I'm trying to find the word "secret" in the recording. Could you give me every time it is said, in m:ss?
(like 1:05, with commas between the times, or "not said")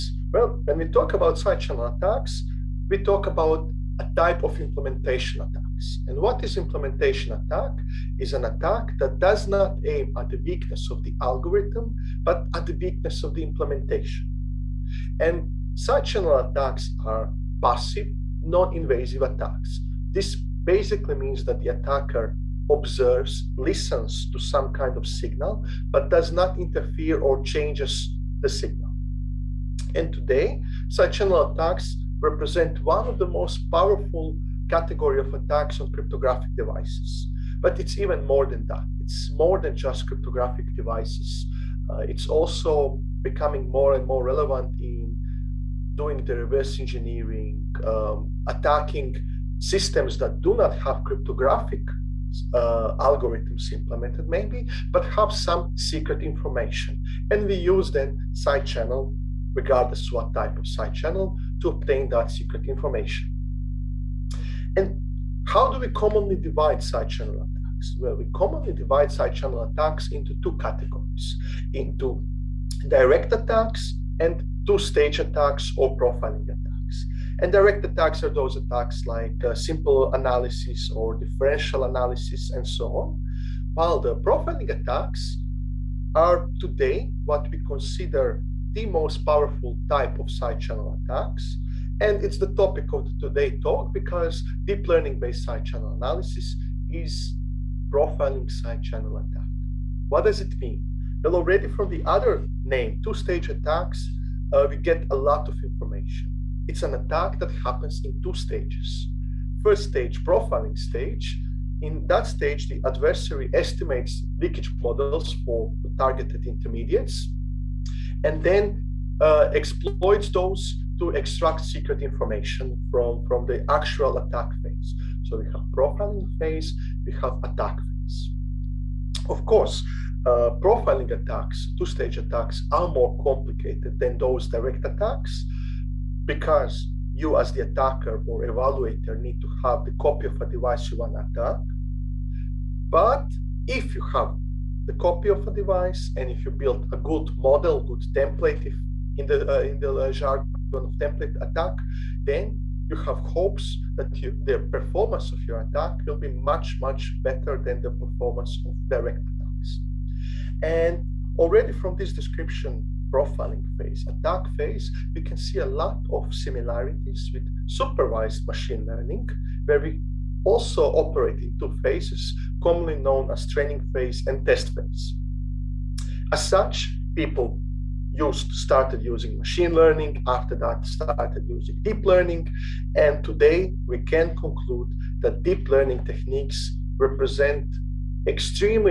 0:55, 1:02, 2:01.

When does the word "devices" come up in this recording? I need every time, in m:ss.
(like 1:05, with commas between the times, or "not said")
0:36, 0:40, 2:20, 2:25.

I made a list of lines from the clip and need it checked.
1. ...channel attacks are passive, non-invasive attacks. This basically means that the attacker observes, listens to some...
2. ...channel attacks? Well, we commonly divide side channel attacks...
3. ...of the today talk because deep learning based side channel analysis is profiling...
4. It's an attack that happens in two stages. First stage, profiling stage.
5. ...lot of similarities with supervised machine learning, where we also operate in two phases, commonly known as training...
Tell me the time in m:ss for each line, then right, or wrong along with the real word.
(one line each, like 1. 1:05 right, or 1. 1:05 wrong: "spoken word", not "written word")
1. 0:16 right
2. 1:07 right
3. 1:32 right
4. 1:46 right
5. 2:45 right.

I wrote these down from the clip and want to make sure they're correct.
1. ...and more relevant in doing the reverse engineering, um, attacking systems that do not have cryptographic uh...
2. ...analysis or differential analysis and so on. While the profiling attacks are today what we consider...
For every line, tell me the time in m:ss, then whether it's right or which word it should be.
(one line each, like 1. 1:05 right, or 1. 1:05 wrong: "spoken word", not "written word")
1. 0:43 right
2. 1:20 right.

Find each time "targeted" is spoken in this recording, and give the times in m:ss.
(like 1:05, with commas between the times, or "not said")
1:55.